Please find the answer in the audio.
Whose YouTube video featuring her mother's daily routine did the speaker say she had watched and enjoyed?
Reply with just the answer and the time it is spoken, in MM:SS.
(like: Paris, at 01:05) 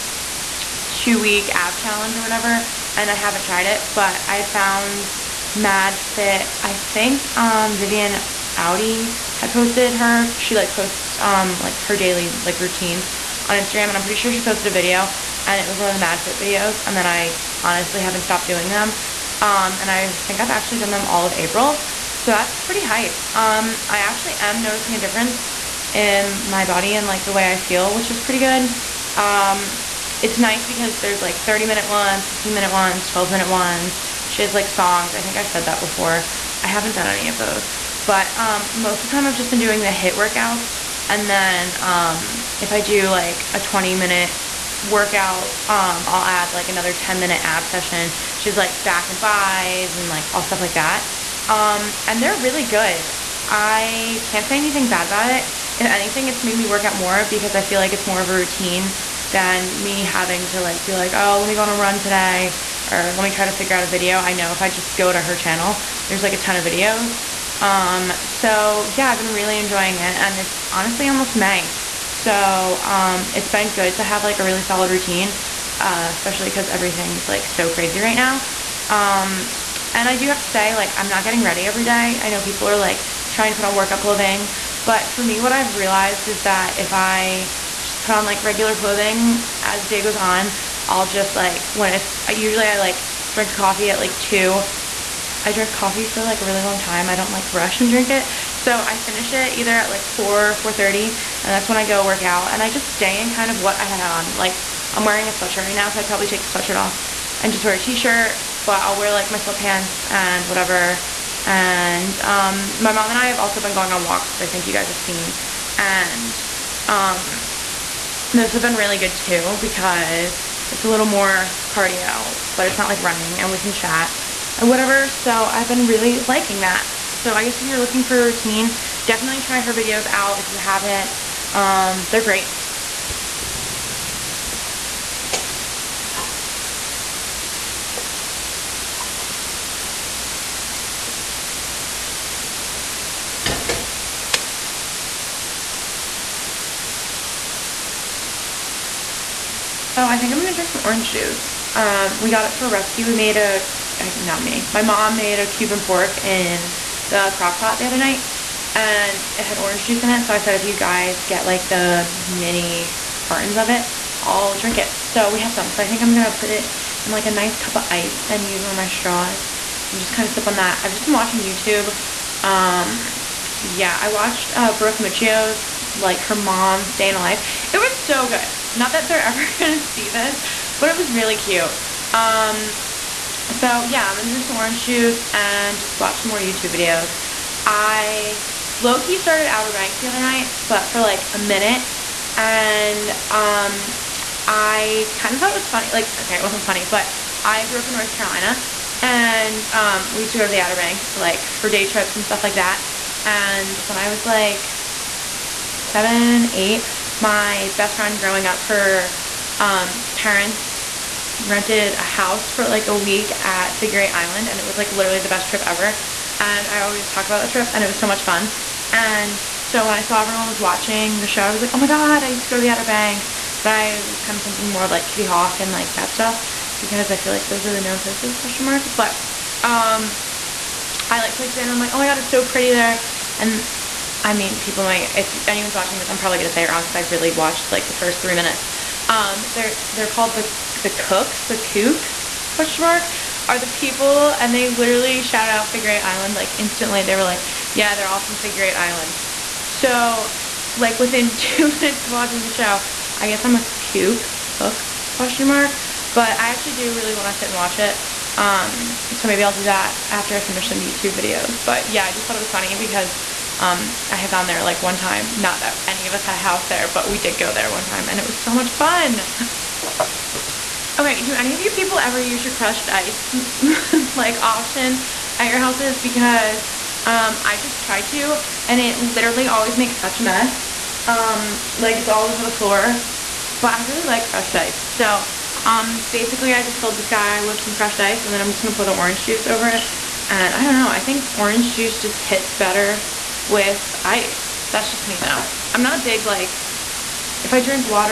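Brooke Miccio, at 02:54.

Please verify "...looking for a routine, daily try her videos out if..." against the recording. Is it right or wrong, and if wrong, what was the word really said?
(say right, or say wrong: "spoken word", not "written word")
wrong: "definitely", not "daily".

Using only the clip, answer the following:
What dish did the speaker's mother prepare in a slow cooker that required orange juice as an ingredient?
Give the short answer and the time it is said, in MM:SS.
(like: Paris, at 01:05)
Cuban pork, at 02:35.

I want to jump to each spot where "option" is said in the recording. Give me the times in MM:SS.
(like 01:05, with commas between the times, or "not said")
04:34.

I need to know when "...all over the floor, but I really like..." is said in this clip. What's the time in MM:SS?
04:42.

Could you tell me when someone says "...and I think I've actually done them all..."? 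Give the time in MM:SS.
00:19.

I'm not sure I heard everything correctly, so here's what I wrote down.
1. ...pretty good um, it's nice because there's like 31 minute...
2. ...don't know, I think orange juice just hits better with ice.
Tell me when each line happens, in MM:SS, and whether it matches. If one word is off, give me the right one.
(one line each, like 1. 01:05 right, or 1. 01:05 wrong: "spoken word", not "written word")
1. 00:28 wrong: "30", not "31"
2. 04:50 right.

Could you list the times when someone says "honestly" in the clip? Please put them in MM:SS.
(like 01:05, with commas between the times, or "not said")
00:17, 01:10.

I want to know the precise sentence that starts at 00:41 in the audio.
And then um, if I do like a 20 minute workout, um, I'll add like another 10 minute ab session.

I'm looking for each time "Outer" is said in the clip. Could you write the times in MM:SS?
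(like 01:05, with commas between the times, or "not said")
03:09, 03:20, 03:42.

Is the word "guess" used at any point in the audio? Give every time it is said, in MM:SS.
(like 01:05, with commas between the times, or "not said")
02:07, 04:13.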